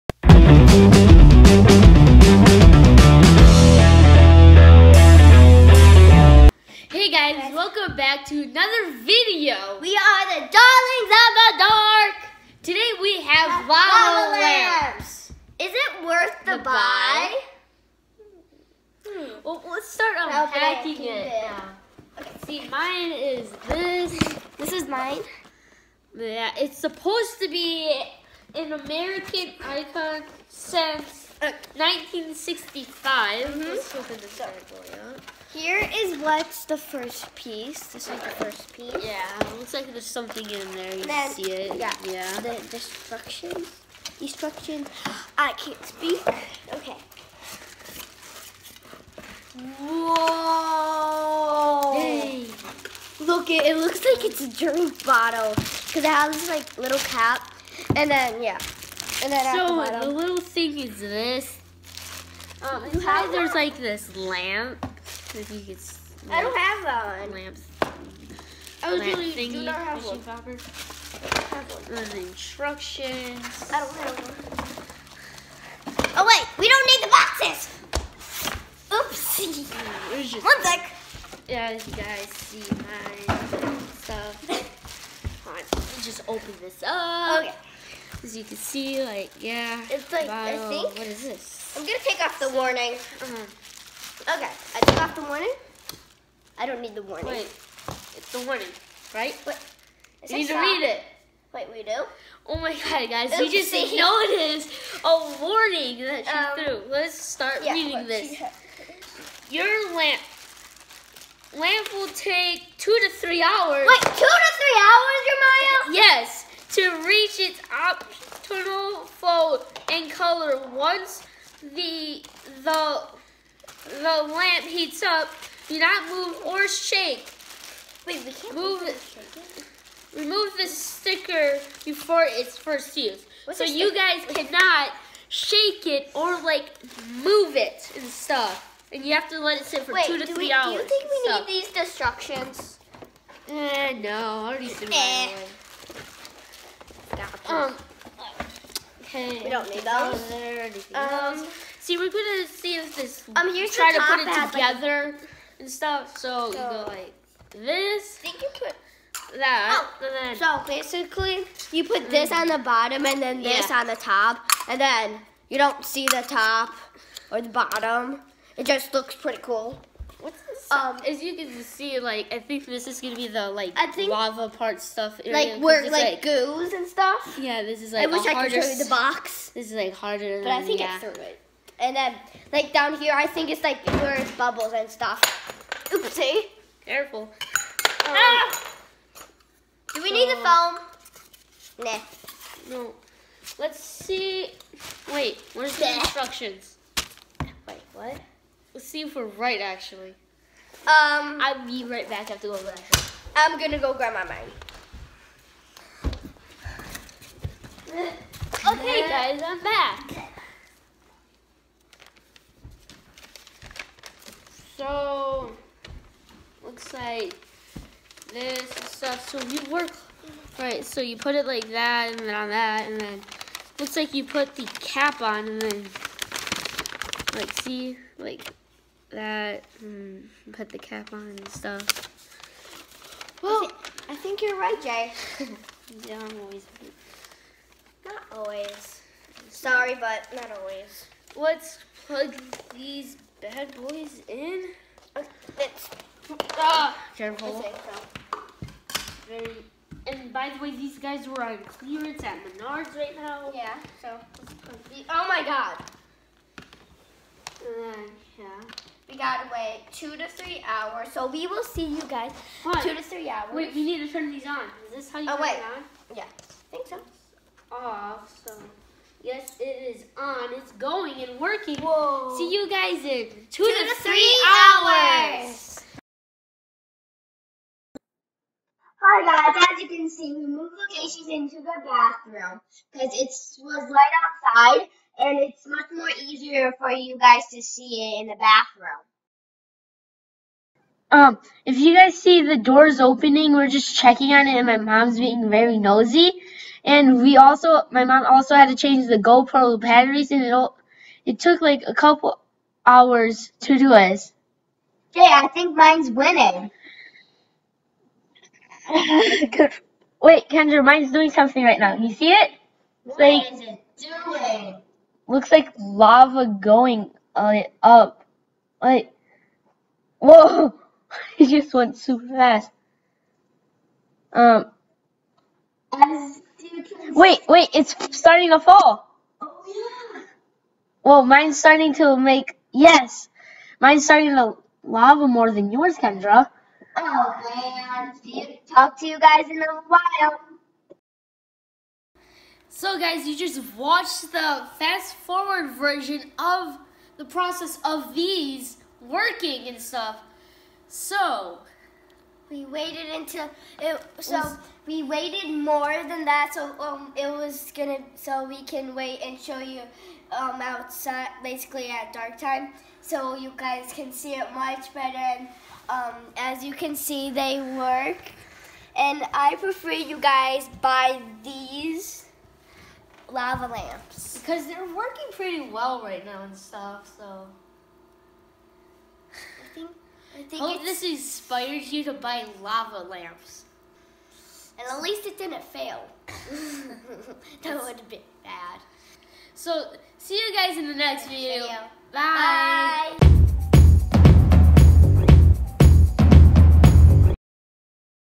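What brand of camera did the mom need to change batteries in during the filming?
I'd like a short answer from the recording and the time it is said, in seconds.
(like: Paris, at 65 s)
GoPro, at 299 s.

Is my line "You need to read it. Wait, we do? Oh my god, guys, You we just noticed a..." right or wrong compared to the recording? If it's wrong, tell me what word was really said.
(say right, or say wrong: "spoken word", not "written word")
right.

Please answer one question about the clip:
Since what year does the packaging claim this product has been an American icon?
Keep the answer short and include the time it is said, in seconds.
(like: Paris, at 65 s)
1965, at 31 s.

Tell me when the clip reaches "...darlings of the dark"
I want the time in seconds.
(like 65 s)
10 s.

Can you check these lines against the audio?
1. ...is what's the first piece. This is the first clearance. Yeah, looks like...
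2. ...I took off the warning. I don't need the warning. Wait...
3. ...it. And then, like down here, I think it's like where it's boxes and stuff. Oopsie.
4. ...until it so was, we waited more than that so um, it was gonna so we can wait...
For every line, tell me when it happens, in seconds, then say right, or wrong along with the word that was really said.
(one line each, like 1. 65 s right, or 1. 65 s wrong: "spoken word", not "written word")
1. 35 s wrong: "piece", not "clearance"
2. 94 s right
3. 181 s wrong: "bubbles", not "boxes"
4. 353 s right.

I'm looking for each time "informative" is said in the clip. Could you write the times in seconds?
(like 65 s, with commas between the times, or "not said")
not said.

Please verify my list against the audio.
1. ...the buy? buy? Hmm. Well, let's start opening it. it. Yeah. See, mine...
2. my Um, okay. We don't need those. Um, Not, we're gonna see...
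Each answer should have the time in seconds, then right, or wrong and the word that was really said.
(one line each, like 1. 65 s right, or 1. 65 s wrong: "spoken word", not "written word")
1. 16 s wrong: "unpacking", not "opening"
2. 147 s wrong: "See", not "Not".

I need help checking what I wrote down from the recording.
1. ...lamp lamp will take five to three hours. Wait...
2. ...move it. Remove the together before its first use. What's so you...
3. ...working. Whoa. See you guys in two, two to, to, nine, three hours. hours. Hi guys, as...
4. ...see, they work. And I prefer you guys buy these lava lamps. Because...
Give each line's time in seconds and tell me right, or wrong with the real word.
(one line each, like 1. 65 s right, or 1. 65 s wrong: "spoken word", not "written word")
1. 109 s wrong: "two", not "five"
2. 128 s wrong: "sticker", not "together"
3. 271 s wrong: "three", not "nine"
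4. 366 s right.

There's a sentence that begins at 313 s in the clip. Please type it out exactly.
It's what like, is it doing?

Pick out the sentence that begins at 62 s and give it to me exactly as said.
Um, you have there's like this lamp like you could.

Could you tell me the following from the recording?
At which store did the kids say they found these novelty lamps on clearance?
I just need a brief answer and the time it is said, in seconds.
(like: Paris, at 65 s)
Menards, at 252 s.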